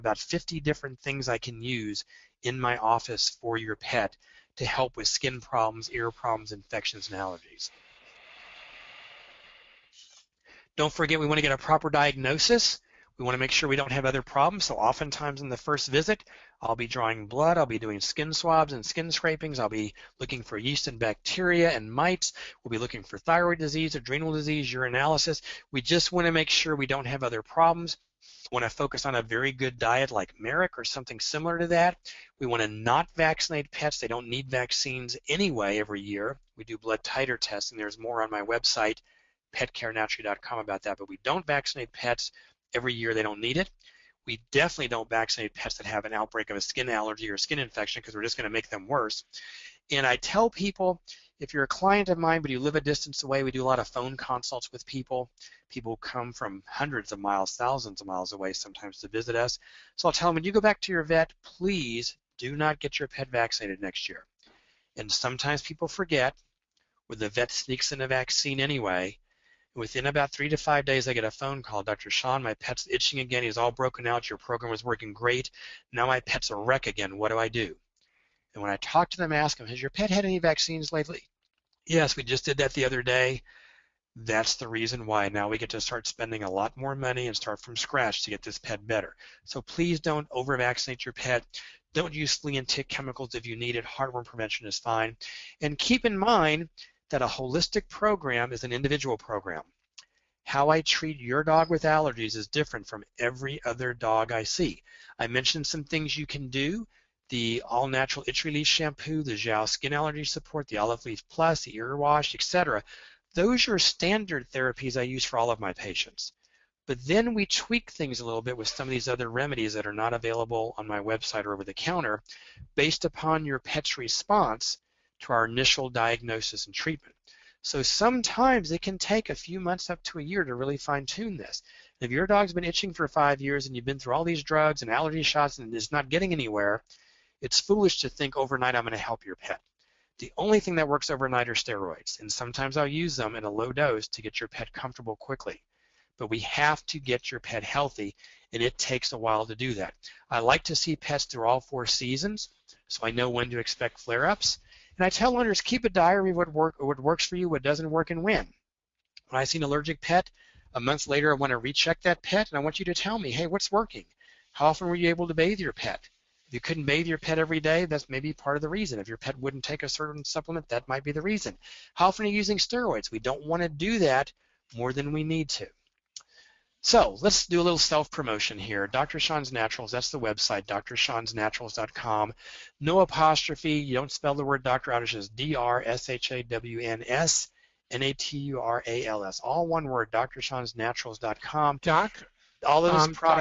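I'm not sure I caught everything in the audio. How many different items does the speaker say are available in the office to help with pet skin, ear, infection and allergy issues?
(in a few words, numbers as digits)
50.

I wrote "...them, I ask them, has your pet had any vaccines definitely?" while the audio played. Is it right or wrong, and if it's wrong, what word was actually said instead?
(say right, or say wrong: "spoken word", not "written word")
wrong: "lately", not "definitely".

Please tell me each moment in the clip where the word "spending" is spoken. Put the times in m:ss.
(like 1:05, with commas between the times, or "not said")
1:26.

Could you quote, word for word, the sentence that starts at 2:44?
How often were you able to bathe your pet?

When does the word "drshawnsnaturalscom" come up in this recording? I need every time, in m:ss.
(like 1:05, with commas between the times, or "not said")
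3:00, 3:10.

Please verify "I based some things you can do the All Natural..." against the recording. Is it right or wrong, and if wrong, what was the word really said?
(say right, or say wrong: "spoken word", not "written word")
wrong: "mentioned", not "based".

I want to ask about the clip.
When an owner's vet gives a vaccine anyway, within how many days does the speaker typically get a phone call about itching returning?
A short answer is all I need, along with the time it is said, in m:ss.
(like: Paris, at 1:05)
3 to 5 days, at 1:10.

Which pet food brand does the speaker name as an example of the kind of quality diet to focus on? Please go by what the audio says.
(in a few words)
Merrick.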